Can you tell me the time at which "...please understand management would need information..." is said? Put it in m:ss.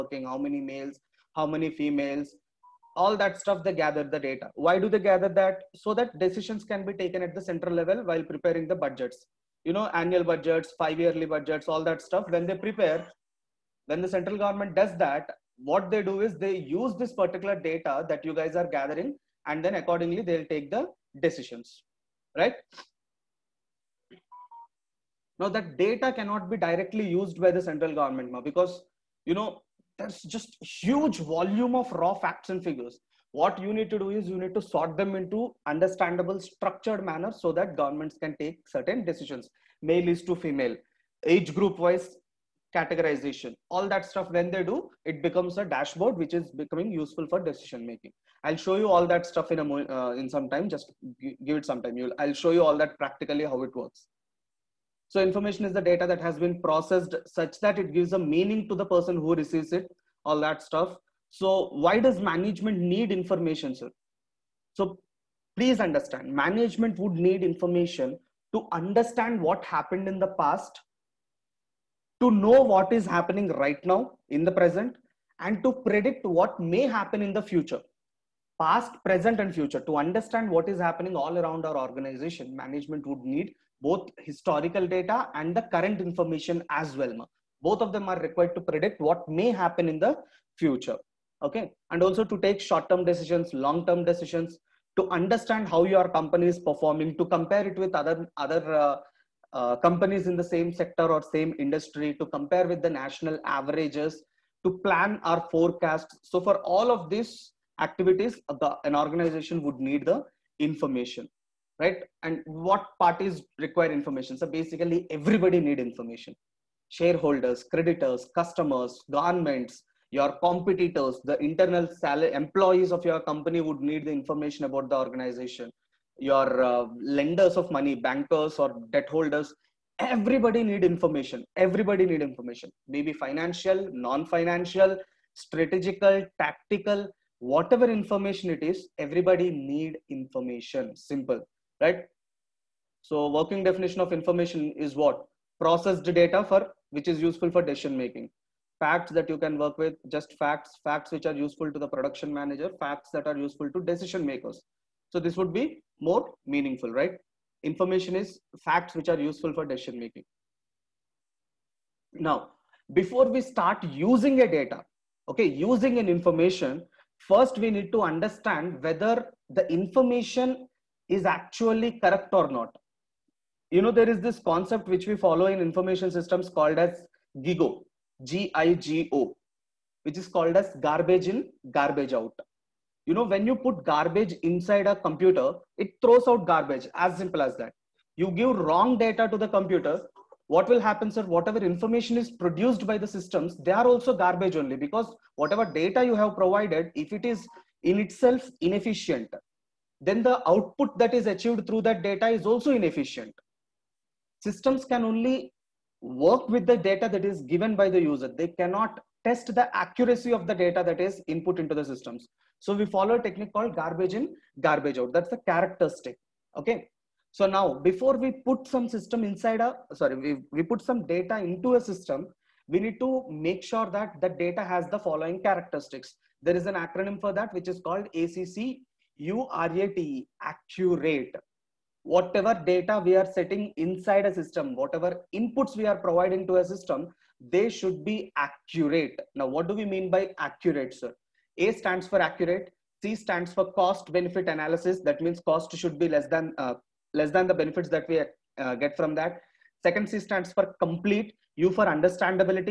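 1:05.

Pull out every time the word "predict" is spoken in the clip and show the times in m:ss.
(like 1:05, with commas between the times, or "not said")
1:15, 1:28.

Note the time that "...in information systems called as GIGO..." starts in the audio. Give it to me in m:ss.
2:55.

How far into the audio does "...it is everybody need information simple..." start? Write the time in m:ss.
2:18.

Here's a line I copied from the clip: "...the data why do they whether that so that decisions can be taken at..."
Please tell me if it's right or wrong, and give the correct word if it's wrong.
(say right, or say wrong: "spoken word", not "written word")
wrong: "gather", not "whether".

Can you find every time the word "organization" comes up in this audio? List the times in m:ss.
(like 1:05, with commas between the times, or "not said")
1:21, 1:48, 2:04.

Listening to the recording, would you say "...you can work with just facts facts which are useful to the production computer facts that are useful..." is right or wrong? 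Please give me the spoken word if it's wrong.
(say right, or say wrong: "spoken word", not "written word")
wrong: "manager", not "computer".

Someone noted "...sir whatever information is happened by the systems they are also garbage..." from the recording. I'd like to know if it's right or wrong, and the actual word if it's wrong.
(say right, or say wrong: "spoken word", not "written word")
wrong: "produced", not "happened".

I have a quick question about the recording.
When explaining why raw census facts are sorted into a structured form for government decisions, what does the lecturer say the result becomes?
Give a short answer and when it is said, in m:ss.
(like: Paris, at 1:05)
A dashboard, at 0:45.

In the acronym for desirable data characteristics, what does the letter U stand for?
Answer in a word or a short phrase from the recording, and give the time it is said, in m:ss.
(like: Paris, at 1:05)
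Understandability, at 4:11.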